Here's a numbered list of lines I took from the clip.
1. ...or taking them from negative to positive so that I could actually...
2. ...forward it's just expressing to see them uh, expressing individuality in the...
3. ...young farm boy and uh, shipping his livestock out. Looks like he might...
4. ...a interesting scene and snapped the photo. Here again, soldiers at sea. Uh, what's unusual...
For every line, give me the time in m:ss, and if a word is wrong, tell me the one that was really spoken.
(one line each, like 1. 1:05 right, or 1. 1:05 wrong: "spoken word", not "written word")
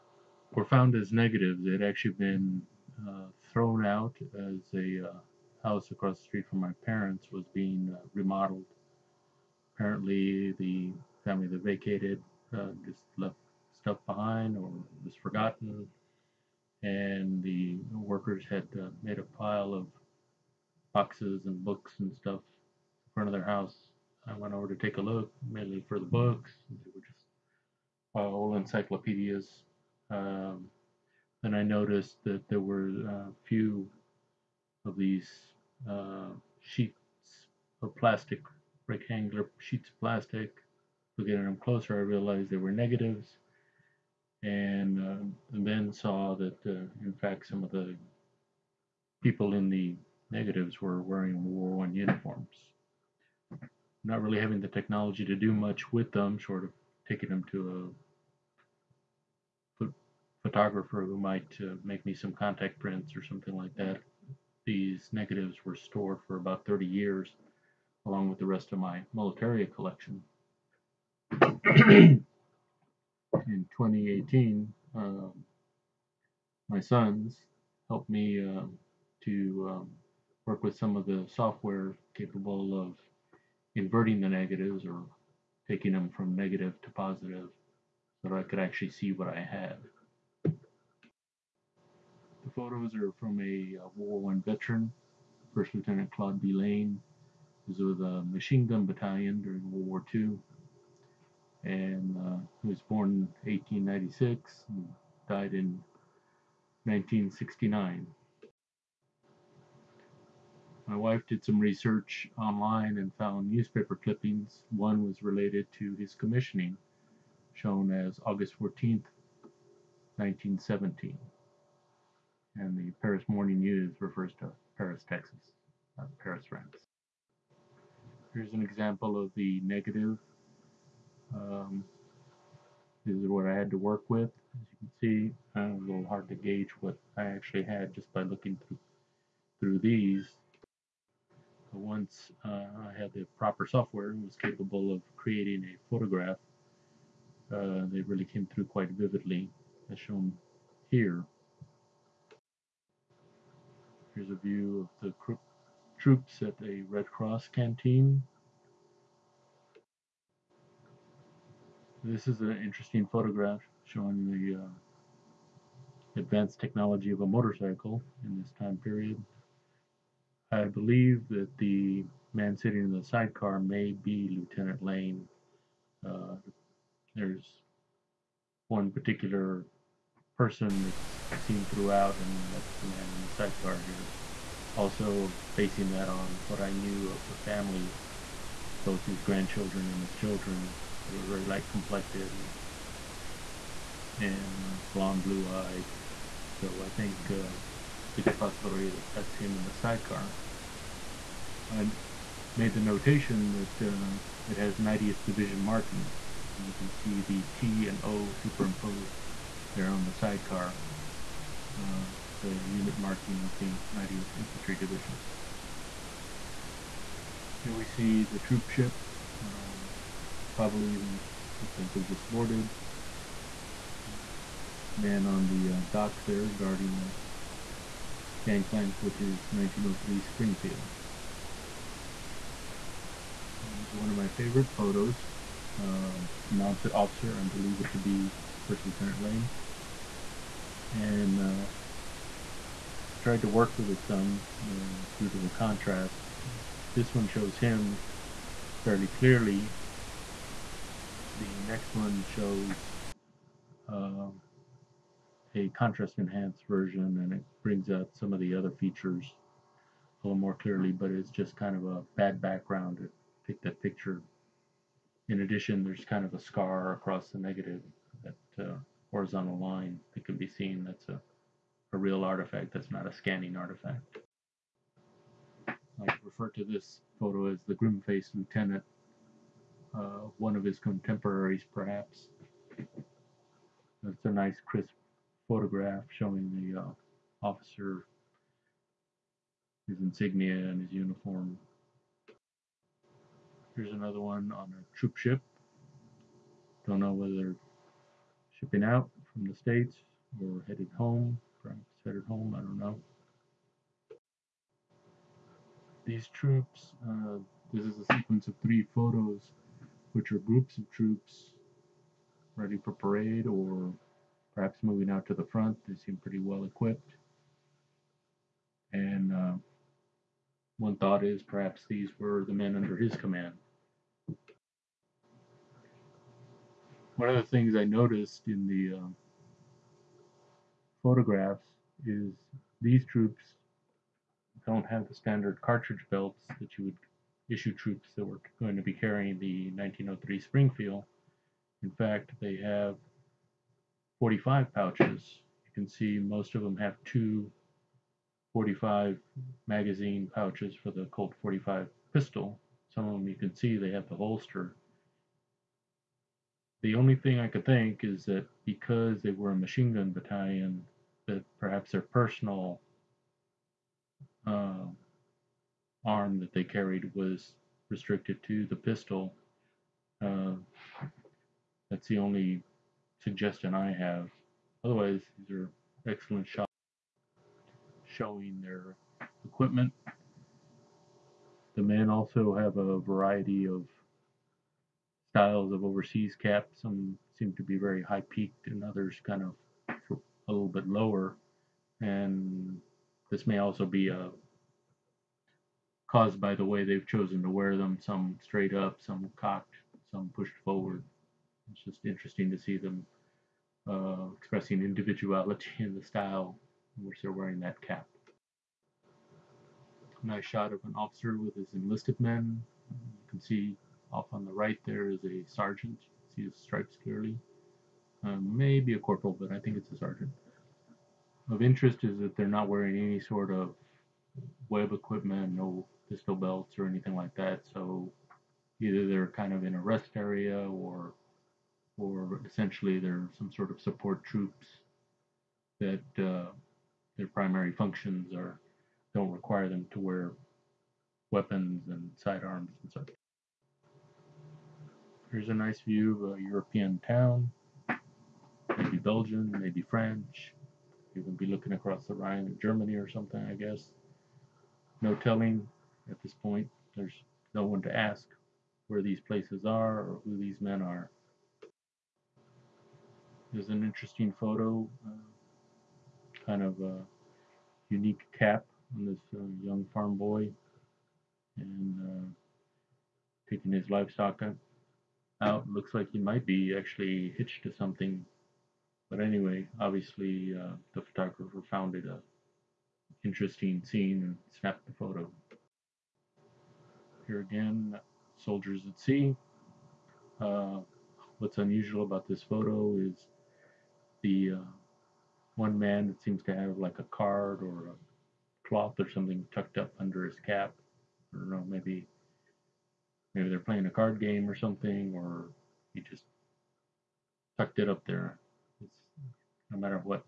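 1. 1:24 right
2. 6:40 wrong: "interesting", not "expressing"
3. 7:49 wrong: "taking", not "shipping"
4. 8:02 right.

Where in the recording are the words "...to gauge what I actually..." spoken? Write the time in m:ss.
2:16.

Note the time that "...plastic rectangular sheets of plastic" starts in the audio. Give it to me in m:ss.
0:37.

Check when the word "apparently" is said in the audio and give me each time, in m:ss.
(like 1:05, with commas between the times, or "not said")
0:09.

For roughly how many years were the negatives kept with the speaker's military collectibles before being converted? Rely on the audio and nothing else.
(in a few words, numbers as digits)
30.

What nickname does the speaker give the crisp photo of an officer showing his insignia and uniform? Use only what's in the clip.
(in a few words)
The grim-faced lieutenant.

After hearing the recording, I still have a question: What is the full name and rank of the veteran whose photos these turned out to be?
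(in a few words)
First Lieutenant Claude B. Lane.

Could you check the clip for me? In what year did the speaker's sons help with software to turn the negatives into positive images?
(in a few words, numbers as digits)
2018.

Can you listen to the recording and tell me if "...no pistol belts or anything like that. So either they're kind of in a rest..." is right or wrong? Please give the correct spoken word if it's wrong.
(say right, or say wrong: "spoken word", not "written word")
right.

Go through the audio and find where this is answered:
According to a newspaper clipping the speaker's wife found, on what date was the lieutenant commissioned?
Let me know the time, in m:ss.
1:58.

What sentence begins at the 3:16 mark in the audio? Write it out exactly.
So I think uh, it's a good possibility that that's him in the sidecar.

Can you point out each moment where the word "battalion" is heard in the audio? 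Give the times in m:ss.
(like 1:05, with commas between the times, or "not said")
1:38, 6:00.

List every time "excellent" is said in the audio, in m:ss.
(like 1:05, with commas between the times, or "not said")
6:16.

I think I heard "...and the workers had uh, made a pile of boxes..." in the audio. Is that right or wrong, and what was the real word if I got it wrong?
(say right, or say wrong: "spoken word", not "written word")
right.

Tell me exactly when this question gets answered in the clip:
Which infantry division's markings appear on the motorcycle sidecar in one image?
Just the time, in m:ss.
3:24.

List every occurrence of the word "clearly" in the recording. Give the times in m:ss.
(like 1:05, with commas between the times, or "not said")
4:09, 4:20, 6:57.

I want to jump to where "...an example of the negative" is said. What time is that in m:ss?
2:08.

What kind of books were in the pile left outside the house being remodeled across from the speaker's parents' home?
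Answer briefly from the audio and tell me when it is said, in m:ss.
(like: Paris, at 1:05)
Old encyclopedias, at 0:28.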